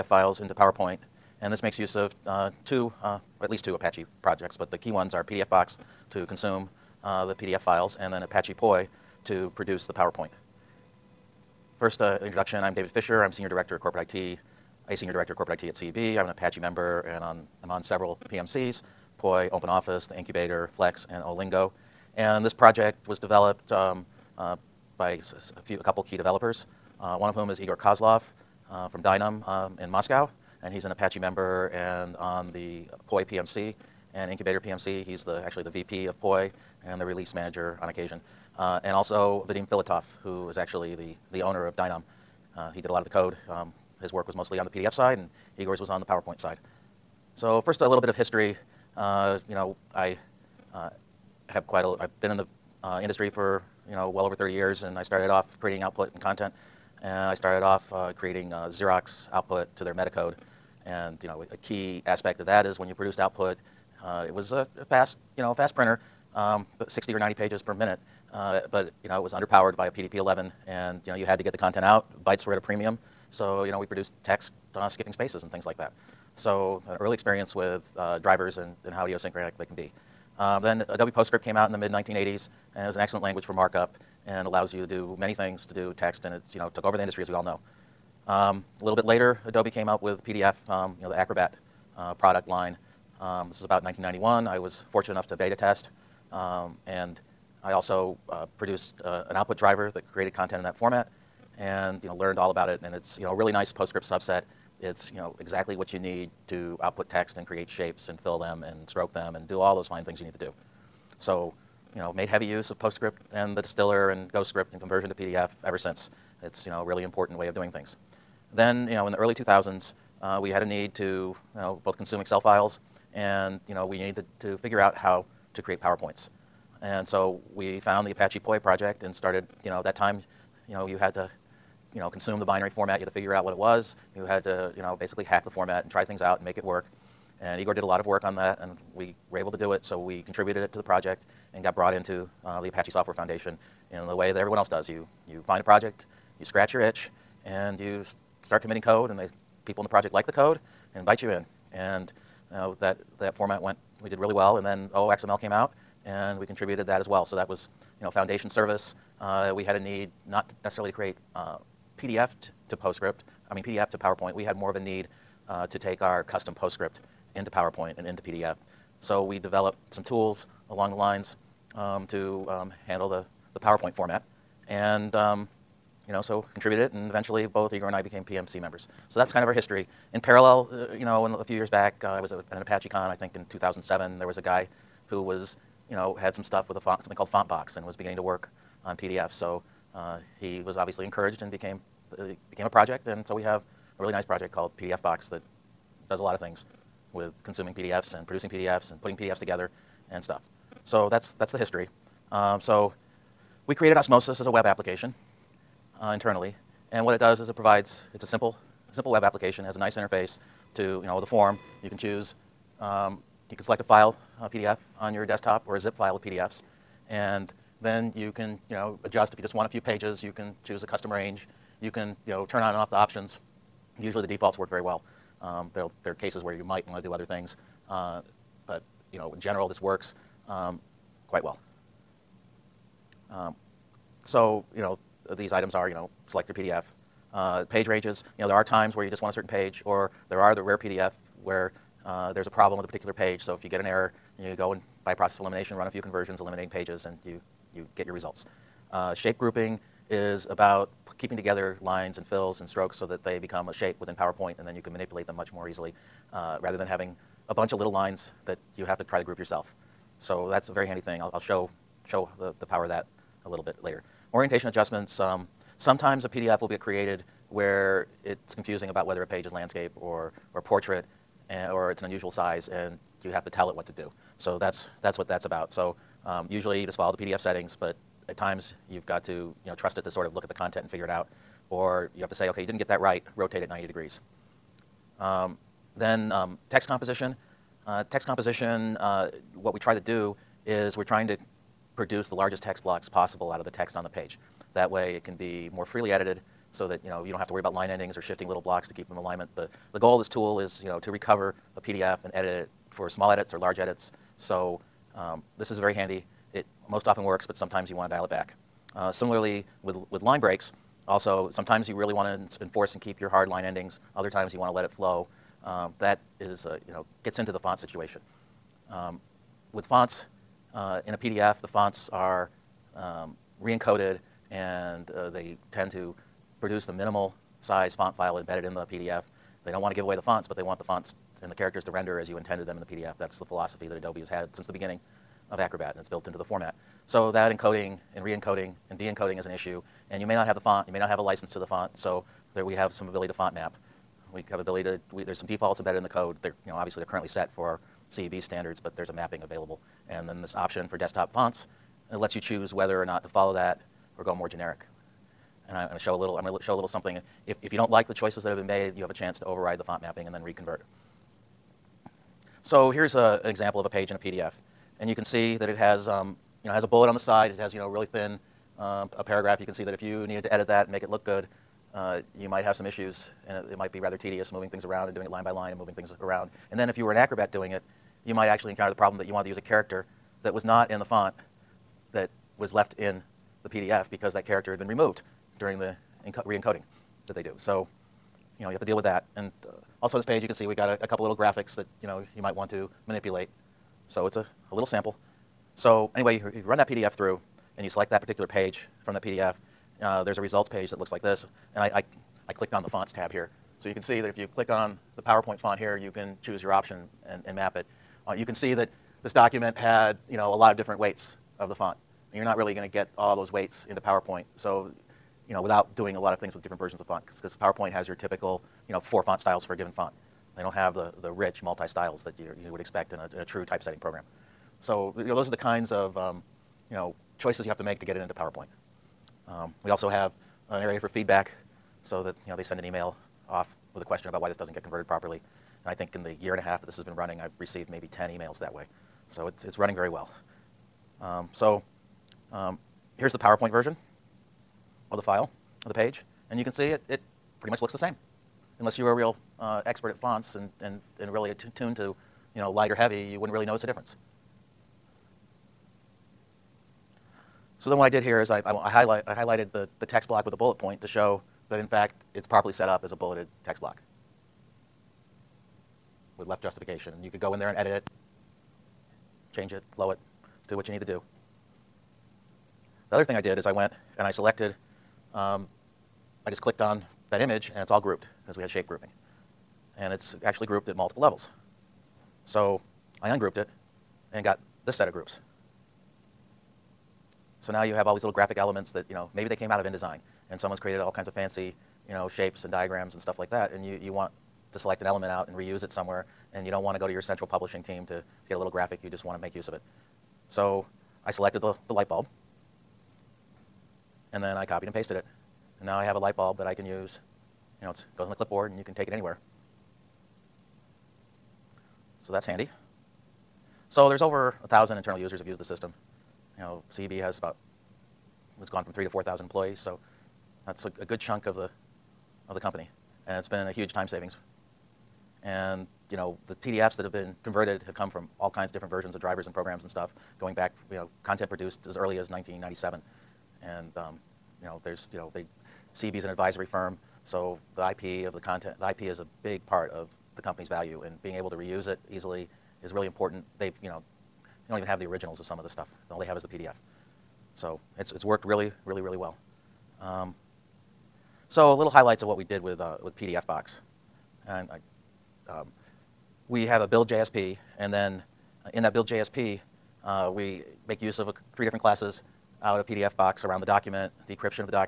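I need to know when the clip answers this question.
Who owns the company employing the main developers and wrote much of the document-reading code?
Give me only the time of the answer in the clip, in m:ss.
0:39.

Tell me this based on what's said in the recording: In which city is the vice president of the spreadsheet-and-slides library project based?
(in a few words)
Moscow.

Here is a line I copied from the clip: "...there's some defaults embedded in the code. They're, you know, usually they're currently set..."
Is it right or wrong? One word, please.
wrong.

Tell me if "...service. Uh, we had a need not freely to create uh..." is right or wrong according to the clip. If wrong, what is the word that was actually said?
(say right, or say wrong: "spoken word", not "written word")
wrong: "necessarily", not "freely".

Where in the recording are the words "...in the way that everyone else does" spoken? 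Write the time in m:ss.
2:23.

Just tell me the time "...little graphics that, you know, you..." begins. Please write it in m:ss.
6:31.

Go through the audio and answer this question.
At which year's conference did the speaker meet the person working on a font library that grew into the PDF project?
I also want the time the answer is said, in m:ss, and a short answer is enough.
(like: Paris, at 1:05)
2007, at 3:03.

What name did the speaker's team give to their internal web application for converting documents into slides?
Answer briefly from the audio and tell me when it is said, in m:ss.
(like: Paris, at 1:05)
Osmosis, at 3:23.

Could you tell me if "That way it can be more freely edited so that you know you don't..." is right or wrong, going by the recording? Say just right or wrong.
right.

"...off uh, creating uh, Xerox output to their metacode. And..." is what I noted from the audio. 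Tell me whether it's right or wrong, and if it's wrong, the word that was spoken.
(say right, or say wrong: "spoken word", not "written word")
right.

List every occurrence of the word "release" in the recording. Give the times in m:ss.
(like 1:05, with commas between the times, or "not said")
0:37.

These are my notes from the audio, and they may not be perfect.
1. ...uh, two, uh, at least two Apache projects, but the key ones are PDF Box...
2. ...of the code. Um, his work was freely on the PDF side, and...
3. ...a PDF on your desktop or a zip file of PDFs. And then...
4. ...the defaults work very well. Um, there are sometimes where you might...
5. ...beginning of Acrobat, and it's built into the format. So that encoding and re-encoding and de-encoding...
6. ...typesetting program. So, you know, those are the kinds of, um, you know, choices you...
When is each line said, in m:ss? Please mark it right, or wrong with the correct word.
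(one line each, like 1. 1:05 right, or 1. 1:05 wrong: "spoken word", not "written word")
1. 0:02 right
2. 0:43 wrong: "mostly", not "freely"
3. 3:34 right
4. 3:44 wrong: "cases", not "sometimes"
5. 5:34 right
6. 7:03 right.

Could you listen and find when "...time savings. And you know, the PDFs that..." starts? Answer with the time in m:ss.
8:43.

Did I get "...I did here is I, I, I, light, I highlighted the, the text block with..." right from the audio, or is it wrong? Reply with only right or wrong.
wrong.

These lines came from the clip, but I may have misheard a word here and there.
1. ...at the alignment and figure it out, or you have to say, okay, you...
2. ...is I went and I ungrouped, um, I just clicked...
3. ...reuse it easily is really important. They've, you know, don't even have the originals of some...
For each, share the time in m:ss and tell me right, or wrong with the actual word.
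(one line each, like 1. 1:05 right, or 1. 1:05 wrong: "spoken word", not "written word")
1. 4:40 wrong: "content", not "alignment"
2. 7:53 wrong: "selected", not "ungrouped"
3. 9:01 right.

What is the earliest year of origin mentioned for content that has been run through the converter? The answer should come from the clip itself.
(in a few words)
1997.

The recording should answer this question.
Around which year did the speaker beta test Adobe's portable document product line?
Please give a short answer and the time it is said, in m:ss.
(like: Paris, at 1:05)
1991, at 1:33.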